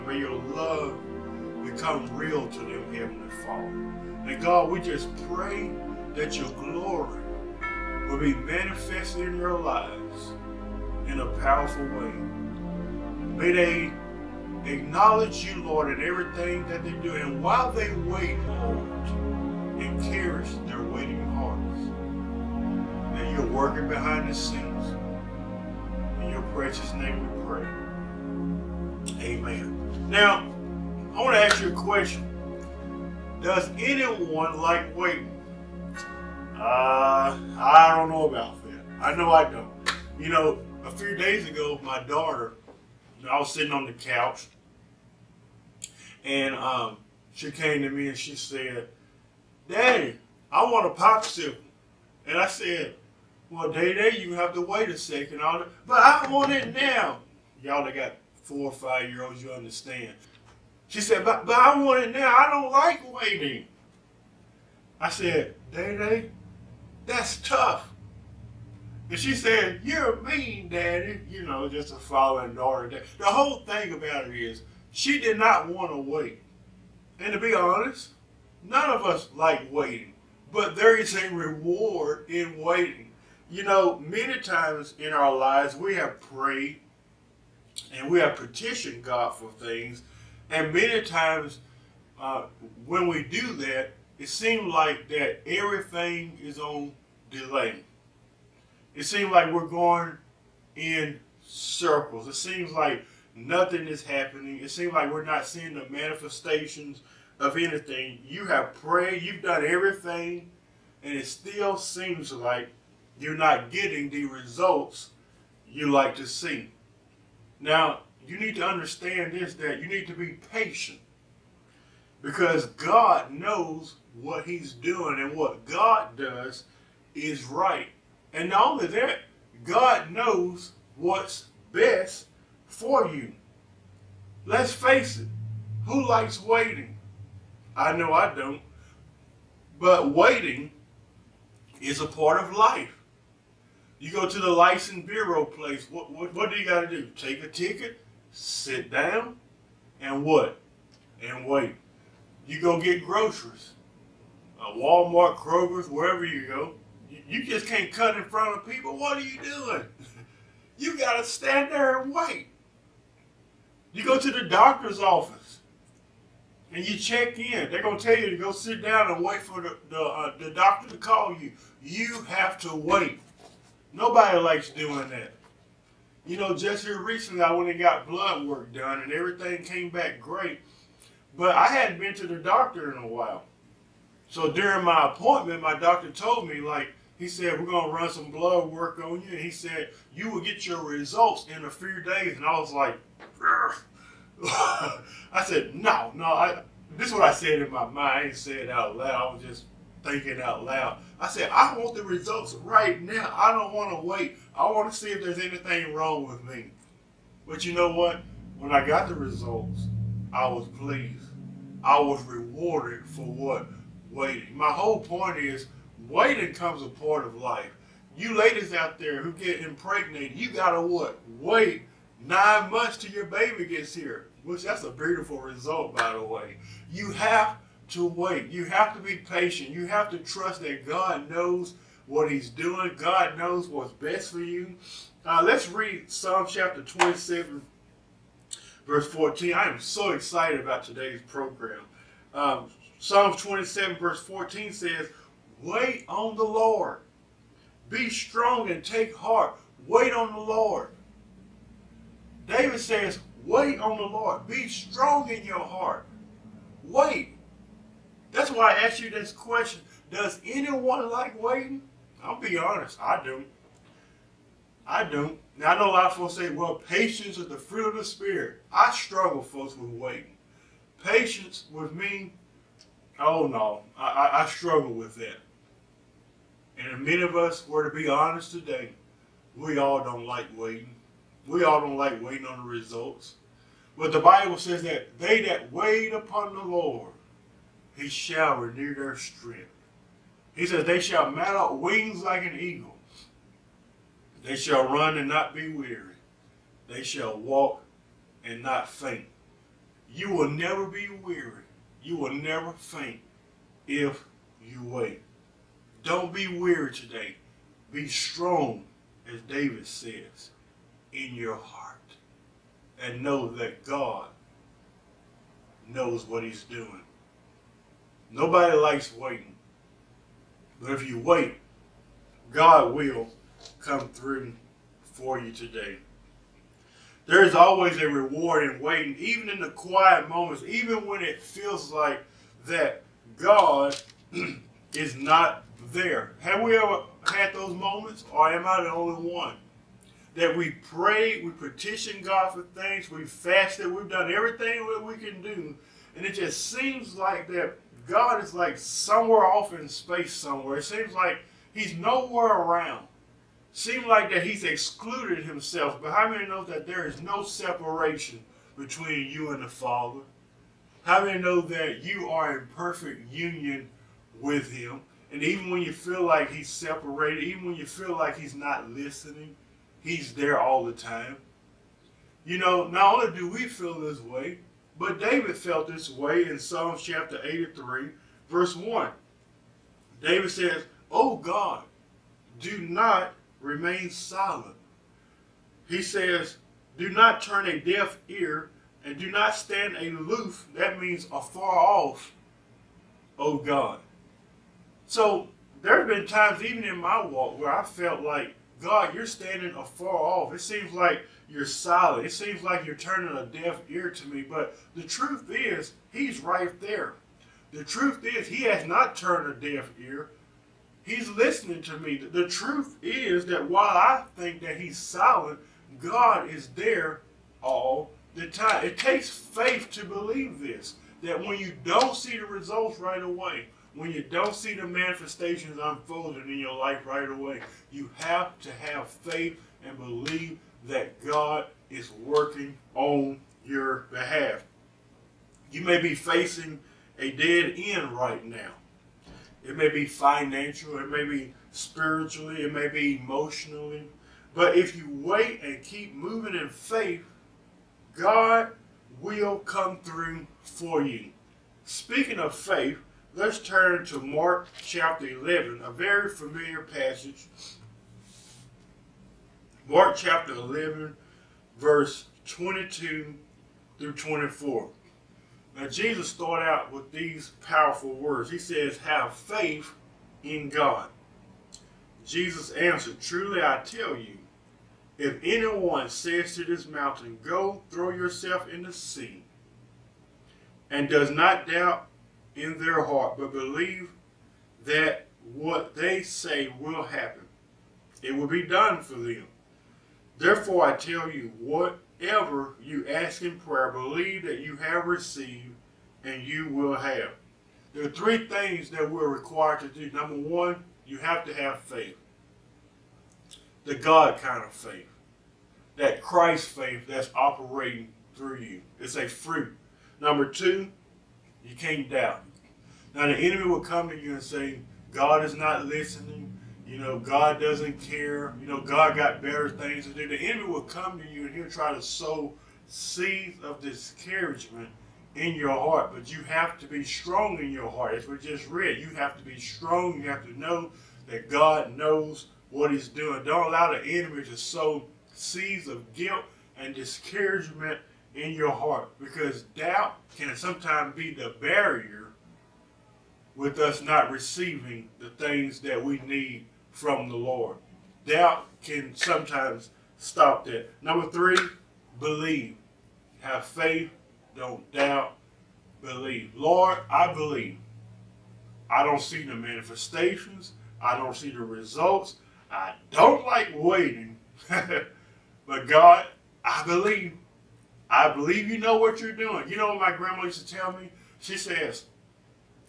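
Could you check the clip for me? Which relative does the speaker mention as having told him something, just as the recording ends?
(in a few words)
grandma.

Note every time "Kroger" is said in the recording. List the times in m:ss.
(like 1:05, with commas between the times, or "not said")
2:35.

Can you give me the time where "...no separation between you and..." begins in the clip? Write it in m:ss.
5:57.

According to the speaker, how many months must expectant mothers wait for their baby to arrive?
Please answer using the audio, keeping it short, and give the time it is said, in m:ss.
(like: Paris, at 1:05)
9, at 3:42.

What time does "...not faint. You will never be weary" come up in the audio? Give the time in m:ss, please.
4:58.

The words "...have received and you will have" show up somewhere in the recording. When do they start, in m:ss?
8:14.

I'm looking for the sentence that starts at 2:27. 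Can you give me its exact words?
Take a ticket, sit down, and what?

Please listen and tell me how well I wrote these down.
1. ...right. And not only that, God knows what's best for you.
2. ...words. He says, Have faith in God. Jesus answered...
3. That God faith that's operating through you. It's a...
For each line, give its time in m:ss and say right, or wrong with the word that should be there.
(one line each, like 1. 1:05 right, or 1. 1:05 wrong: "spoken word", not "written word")
1. 2:07 right
2. 7:48 right
3. 8:25 wrong: "Christ", not "God".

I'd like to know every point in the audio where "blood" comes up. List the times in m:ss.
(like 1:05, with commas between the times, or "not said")
2:58, 3:08.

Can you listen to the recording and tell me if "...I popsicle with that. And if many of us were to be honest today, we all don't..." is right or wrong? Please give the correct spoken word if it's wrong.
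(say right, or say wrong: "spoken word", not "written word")
wrong: "struggle", not "popsicle".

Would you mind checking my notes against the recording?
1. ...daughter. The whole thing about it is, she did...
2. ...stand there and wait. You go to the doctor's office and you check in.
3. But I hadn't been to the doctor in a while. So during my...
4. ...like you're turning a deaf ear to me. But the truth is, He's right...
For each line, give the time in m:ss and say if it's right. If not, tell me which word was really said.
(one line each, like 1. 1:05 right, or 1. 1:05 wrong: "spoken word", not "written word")
1. 1:12 right
2. 2:41 right
3. 3:01 right
4. 6:42 right.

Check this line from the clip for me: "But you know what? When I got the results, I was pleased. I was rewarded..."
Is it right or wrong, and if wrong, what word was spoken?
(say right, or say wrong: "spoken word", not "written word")
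right.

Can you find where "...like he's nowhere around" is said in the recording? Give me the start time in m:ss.
5:51.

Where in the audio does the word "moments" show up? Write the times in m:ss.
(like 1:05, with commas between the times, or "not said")
5:30, 5:37.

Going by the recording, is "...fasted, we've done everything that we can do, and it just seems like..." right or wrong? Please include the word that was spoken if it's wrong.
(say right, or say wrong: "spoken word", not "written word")
right.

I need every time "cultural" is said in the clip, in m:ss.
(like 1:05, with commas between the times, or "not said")
not said.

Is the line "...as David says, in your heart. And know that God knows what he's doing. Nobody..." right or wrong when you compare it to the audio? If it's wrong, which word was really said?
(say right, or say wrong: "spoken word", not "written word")
right.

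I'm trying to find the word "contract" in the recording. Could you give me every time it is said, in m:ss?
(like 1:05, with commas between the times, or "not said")
not said.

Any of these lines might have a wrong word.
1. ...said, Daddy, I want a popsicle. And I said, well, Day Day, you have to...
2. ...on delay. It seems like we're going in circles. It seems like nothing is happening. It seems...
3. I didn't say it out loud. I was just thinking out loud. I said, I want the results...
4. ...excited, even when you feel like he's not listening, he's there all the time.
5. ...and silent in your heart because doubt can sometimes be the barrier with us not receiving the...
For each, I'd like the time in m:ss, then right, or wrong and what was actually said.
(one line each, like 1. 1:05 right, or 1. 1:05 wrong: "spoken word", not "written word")
1. 0:48 right
2. 1:36 right
3. 3:17 right
4. 6:06 wrong: "separated", not "excited"
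5. 8:56 wrong: "discouragement", not "silent".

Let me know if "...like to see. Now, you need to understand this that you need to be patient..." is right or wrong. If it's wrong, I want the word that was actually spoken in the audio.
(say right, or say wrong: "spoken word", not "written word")
right.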